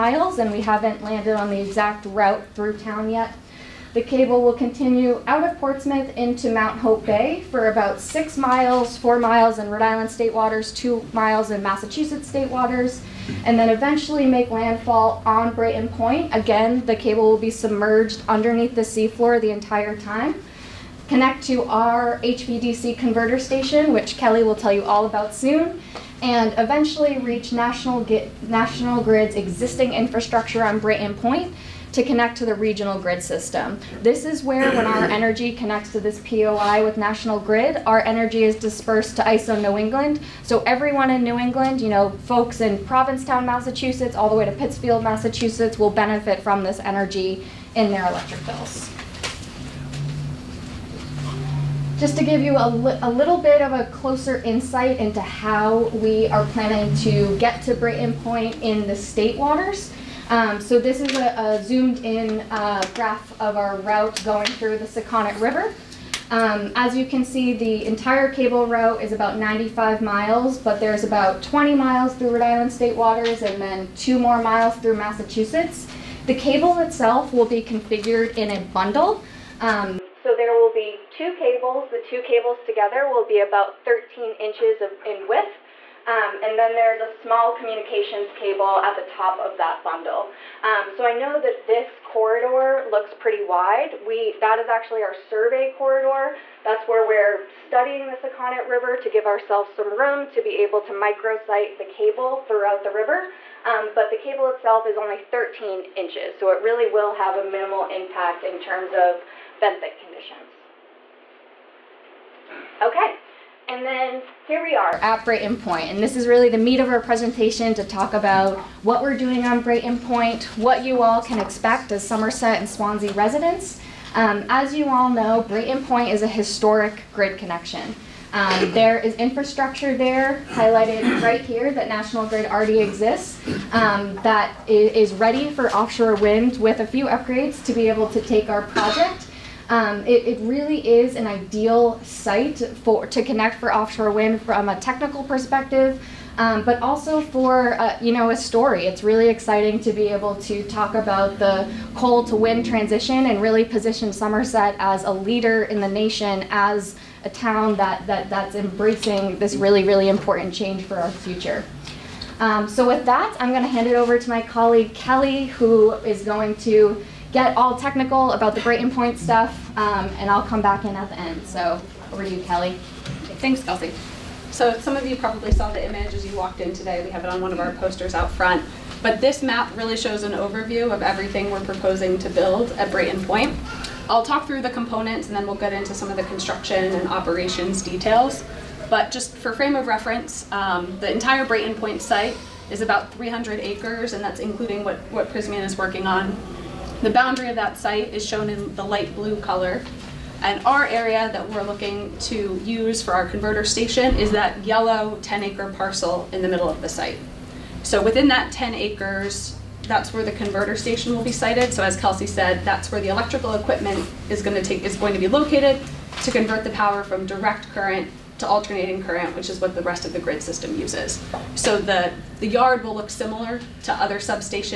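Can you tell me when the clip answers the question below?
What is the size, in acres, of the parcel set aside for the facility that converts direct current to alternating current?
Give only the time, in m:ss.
3:25.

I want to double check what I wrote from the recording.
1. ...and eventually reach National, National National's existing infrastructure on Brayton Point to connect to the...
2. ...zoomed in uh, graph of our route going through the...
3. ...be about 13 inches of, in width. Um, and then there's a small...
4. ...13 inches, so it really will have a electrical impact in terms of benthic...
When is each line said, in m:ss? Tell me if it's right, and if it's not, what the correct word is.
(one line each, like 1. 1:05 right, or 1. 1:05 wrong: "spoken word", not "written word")
1. 0:26 wrong: "Grid", not "National"
2. 1:01 right
3. 1:23 right
4. 1:45 wrong: "minimal", not "electrical".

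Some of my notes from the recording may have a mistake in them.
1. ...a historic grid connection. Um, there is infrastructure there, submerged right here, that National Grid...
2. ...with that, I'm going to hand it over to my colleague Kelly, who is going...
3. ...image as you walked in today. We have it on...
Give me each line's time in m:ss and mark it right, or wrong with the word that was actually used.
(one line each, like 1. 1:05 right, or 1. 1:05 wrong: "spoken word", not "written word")
1. 2:06 wrong: "highlighted", not "submerged"
2. 2:42 right
3. 2:55 right.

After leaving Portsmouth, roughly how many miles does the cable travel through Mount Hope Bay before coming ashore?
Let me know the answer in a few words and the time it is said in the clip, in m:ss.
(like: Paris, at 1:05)
6 miles, at 0:07.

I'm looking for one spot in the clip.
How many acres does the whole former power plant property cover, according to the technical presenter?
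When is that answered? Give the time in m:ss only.
3:13.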